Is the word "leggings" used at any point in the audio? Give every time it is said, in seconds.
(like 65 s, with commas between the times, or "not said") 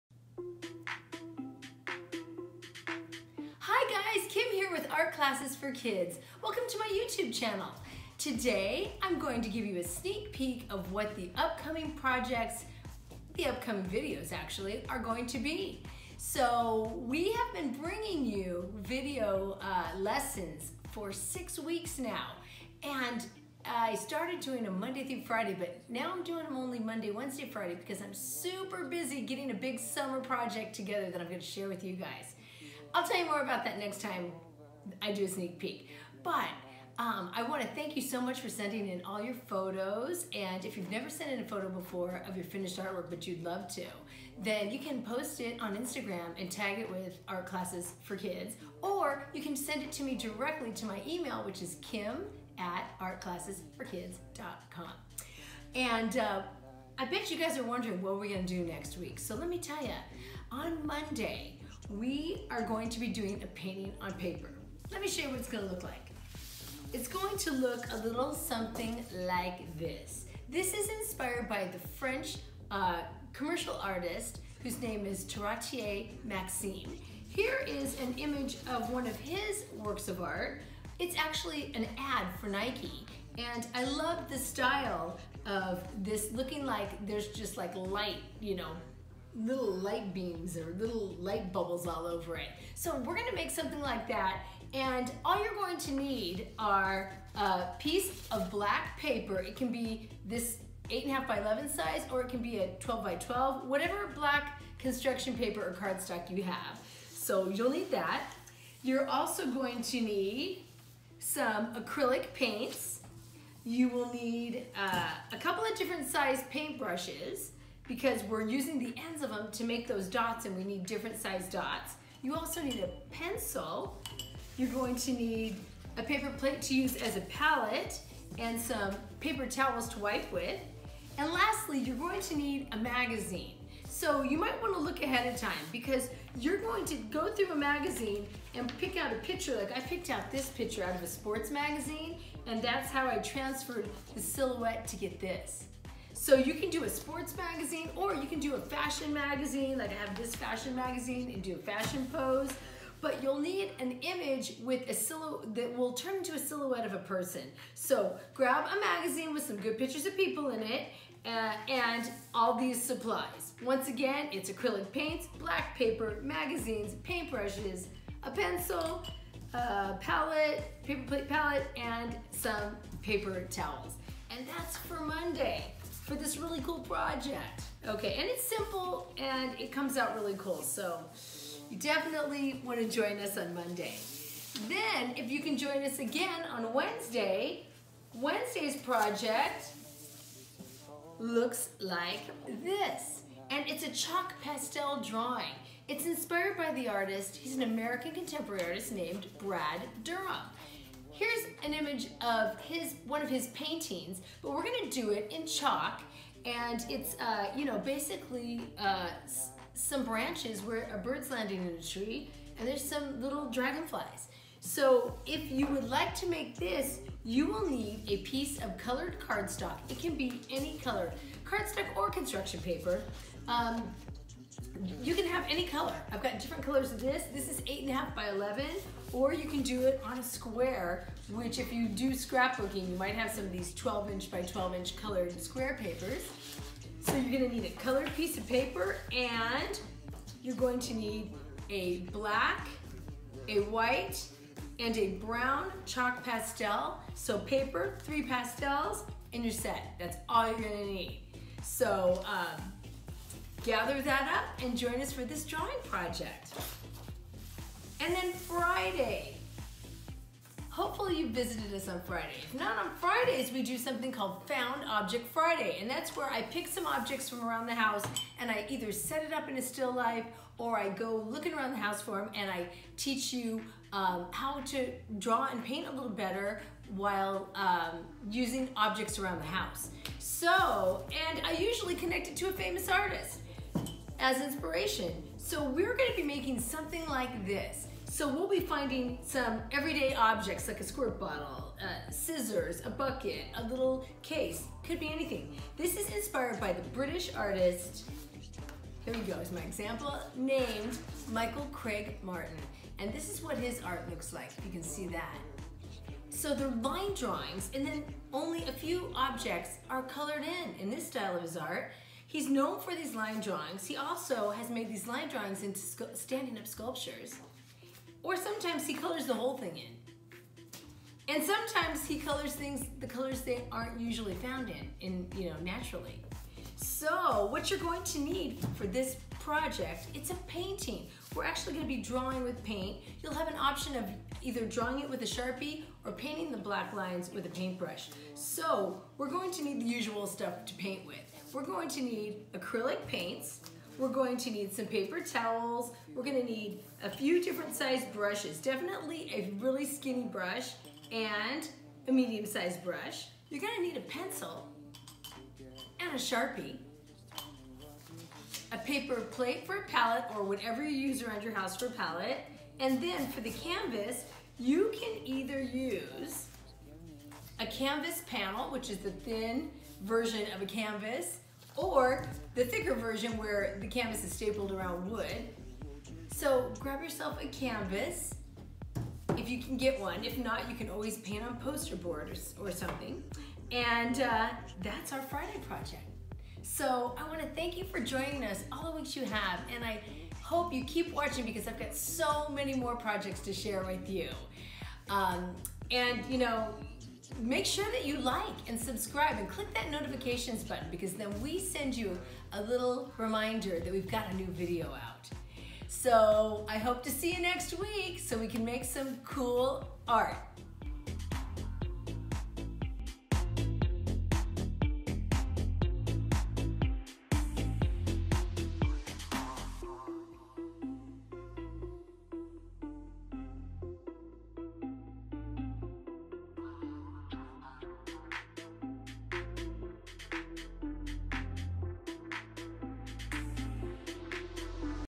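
not said.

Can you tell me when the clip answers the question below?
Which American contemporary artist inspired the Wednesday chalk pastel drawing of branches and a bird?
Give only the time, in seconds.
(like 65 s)
199 s.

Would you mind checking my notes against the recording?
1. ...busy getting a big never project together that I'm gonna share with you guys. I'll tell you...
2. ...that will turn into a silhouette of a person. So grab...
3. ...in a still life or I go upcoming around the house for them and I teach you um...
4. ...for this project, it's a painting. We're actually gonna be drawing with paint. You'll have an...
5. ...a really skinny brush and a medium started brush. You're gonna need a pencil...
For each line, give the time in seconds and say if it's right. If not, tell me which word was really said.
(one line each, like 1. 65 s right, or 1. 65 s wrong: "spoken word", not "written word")
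1. 28 s wrong: "summer", not "never"
2. 155 s right
3. 269 s wrong: "looking", not "upcoming"
4. 328 s right
5. 349 s wrong: "sized", not "started".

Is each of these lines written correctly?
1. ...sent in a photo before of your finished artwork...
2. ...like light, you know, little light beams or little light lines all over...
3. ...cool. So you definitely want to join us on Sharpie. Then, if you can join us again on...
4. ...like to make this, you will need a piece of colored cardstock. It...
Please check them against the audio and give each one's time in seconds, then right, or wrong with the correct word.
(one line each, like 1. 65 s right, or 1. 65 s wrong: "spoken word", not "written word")
1. 41 s right
2. 87 s wrong: "bubbles", not "lines"
3. 180 s wrong: "Monday", not "Sharpie"
4. 215 s right.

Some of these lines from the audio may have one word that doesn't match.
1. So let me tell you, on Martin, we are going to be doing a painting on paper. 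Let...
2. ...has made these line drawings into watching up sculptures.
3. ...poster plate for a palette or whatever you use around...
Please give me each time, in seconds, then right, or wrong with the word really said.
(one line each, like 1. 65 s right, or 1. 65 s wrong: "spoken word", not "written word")
1. 59 s wrong: "Monday", not "Martin"
2. 314 s wrong: "standing", not "watching"
3. 358 s wrong: "paper", not "poster".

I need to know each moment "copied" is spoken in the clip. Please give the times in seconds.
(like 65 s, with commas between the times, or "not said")
not said.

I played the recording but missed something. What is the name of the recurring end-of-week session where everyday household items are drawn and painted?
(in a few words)
Found Object Friday.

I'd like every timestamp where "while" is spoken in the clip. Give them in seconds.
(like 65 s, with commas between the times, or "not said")
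276 s.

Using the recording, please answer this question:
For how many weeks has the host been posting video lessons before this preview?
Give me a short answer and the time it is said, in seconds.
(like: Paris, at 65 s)
6, at 21 s.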